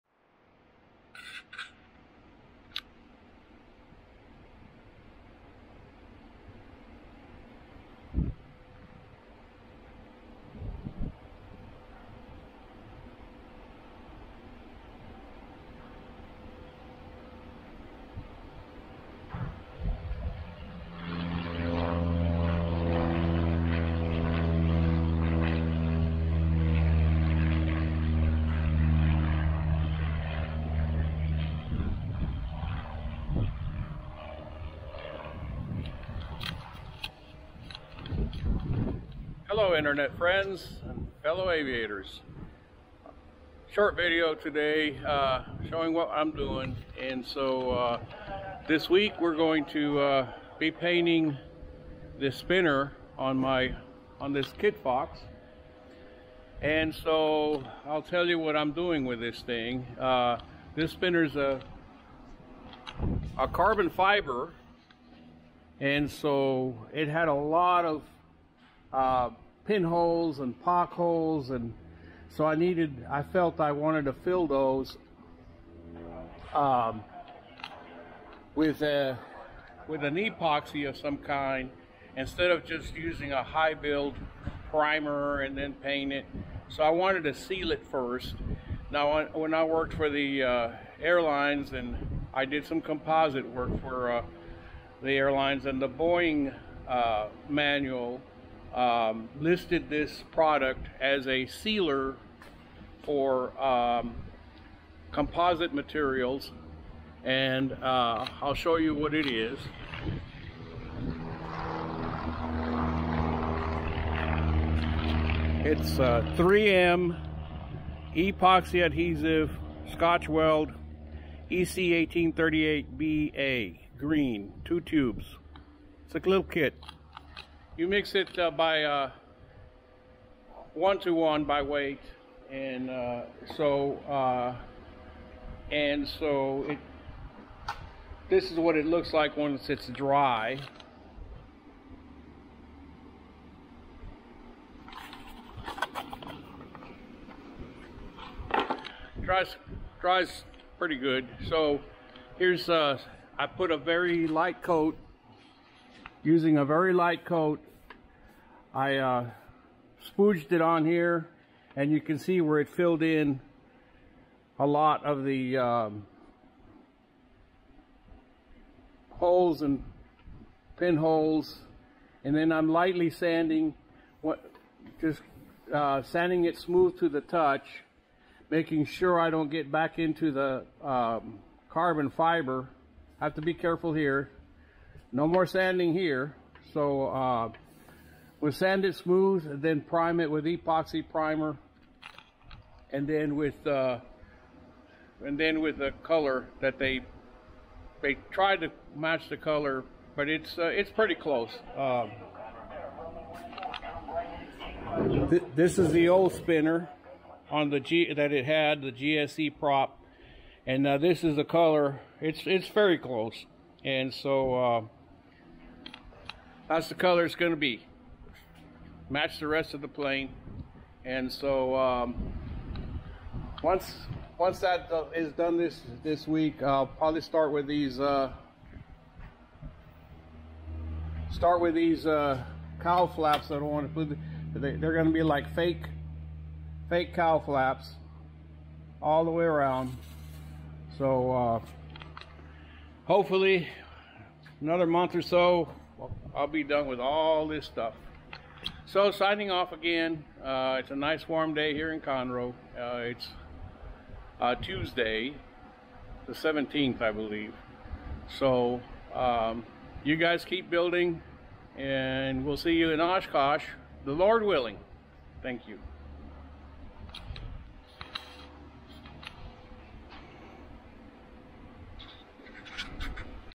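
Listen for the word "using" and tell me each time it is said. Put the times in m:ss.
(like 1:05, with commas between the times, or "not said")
1:22, 2:36.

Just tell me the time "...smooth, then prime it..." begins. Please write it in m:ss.
3:08.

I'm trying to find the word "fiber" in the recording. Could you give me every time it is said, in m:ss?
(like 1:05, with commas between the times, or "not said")
1:03, 3:02.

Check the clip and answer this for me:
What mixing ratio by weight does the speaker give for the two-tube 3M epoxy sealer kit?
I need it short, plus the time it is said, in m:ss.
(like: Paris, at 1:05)
1 to 1, at 2:10.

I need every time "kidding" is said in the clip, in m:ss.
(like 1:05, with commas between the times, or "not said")
not said.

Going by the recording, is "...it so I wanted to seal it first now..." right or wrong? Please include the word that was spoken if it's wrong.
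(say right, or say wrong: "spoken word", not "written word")
right.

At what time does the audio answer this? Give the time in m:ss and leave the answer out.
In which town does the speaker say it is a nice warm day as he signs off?
4:12.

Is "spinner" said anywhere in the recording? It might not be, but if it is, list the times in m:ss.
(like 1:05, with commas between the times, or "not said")
0:52, 3:26.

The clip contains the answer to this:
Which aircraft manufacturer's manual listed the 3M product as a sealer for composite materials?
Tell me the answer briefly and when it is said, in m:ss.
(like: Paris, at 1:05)
Boeing, at 1:35.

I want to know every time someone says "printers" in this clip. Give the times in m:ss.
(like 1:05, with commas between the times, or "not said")
not said.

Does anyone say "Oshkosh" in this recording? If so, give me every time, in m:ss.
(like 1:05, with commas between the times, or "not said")
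4:22.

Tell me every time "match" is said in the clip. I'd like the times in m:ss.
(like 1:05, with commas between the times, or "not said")
3:18, 3:39.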